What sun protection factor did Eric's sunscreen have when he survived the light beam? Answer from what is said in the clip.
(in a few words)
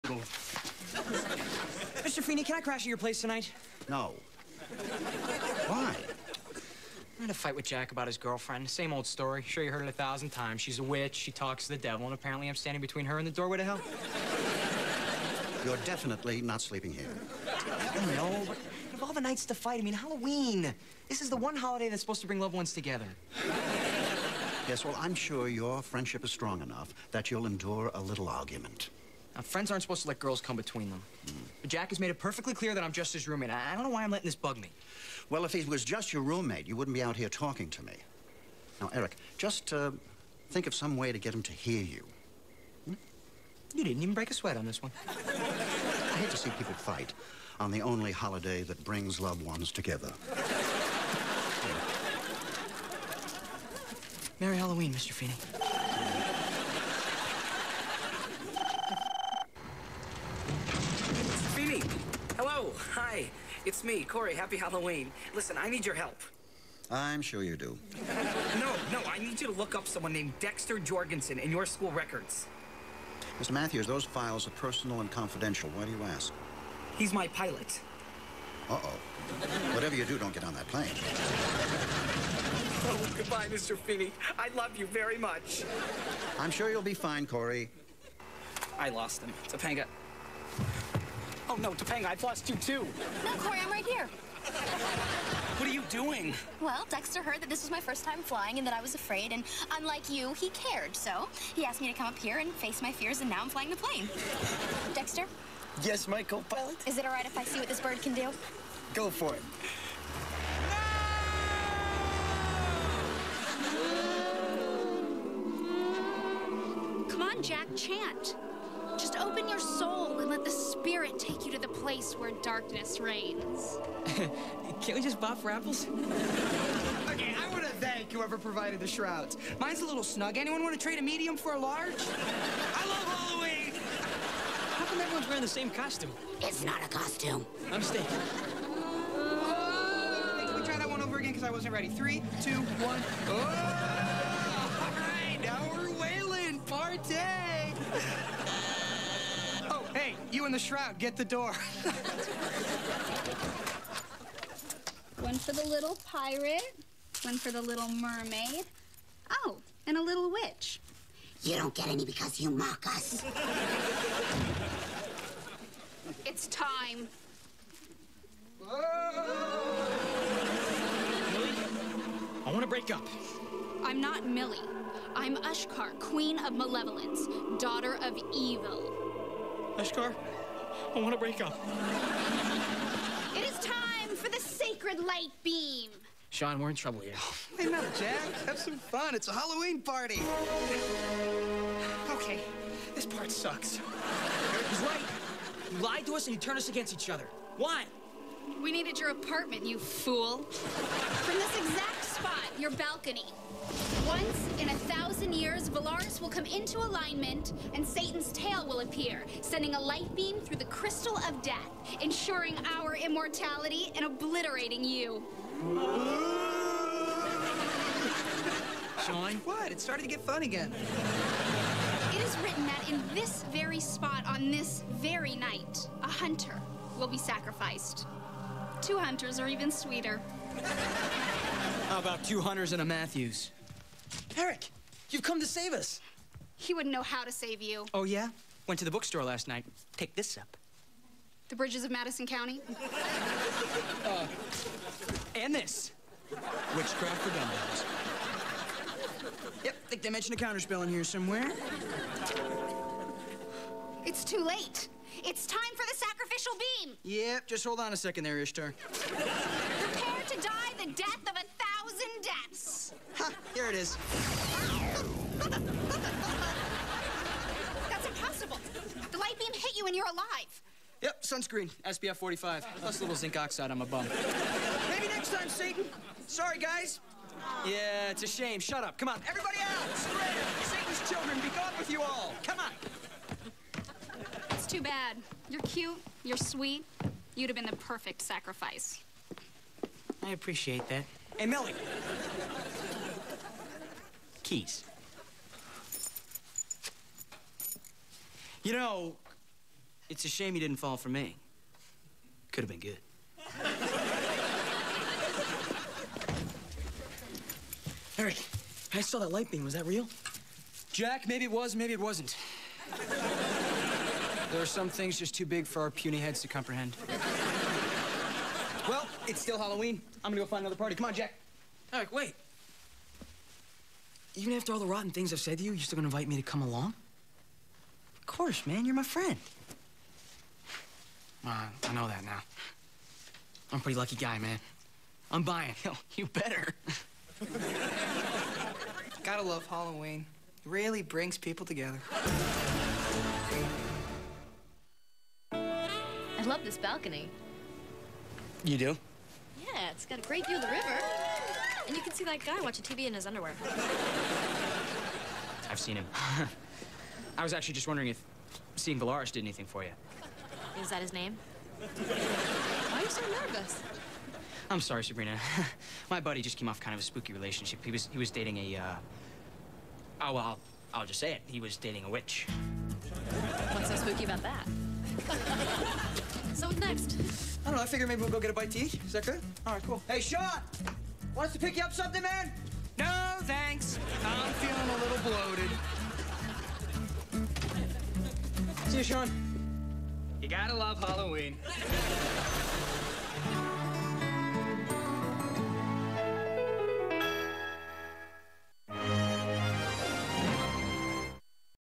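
SPF 45.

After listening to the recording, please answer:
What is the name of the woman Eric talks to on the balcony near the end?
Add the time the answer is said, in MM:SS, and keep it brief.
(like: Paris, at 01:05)
Sabrina, at 06:05.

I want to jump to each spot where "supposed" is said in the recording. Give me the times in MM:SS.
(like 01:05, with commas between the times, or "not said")
00:22, 00:29.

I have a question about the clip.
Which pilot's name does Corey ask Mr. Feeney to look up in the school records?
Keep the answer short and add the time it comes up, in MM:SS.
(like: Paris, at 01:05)
Dexter Jorgensen, at 01:10.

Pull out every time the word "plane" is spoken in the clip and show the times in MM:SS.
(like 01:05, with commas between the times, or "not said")
01:20, 01:43.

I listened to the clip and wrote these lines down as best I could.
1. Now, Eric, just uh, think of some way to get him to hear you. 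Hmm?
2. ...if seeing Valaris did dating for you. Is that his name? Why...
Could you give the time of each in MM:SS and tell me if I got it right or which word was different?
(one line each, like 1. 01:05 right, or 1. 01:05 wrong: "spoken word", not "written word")
1. 00:38 right
2. 05:58 wrong: "anything", not "dating".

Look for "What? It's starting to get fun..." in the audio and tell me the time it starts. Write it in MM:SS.
03:39.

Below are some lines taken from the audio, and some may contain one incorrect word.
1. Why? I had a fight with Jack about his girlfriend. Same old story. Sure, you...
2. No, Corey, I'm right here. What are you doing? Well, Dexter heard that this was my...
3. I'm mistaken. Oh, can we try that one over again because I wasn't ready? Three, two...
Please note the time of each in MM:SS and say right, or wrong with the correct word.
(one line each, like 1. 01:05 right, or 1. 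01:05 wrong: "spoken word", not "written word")
1. 00:05 right
2. 01:33 right
3. 02:17 right.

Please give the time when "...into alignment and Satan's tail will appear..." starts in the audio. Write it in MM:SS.
03:26.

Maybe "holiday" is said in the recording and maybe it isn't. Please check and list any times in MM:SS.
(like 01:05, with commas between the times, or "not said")
00:21, 00:48.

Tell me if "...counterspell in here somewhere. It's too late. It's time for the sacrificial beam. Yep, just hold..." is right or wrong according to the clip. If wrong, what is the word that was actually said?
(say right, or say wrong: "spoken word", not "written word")
right.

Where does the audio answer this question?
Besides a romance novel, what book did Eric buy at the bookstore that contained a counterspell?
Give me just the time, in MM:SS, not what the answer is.
04:06.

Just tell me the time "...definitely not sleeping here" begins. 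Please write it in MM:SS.
00:15.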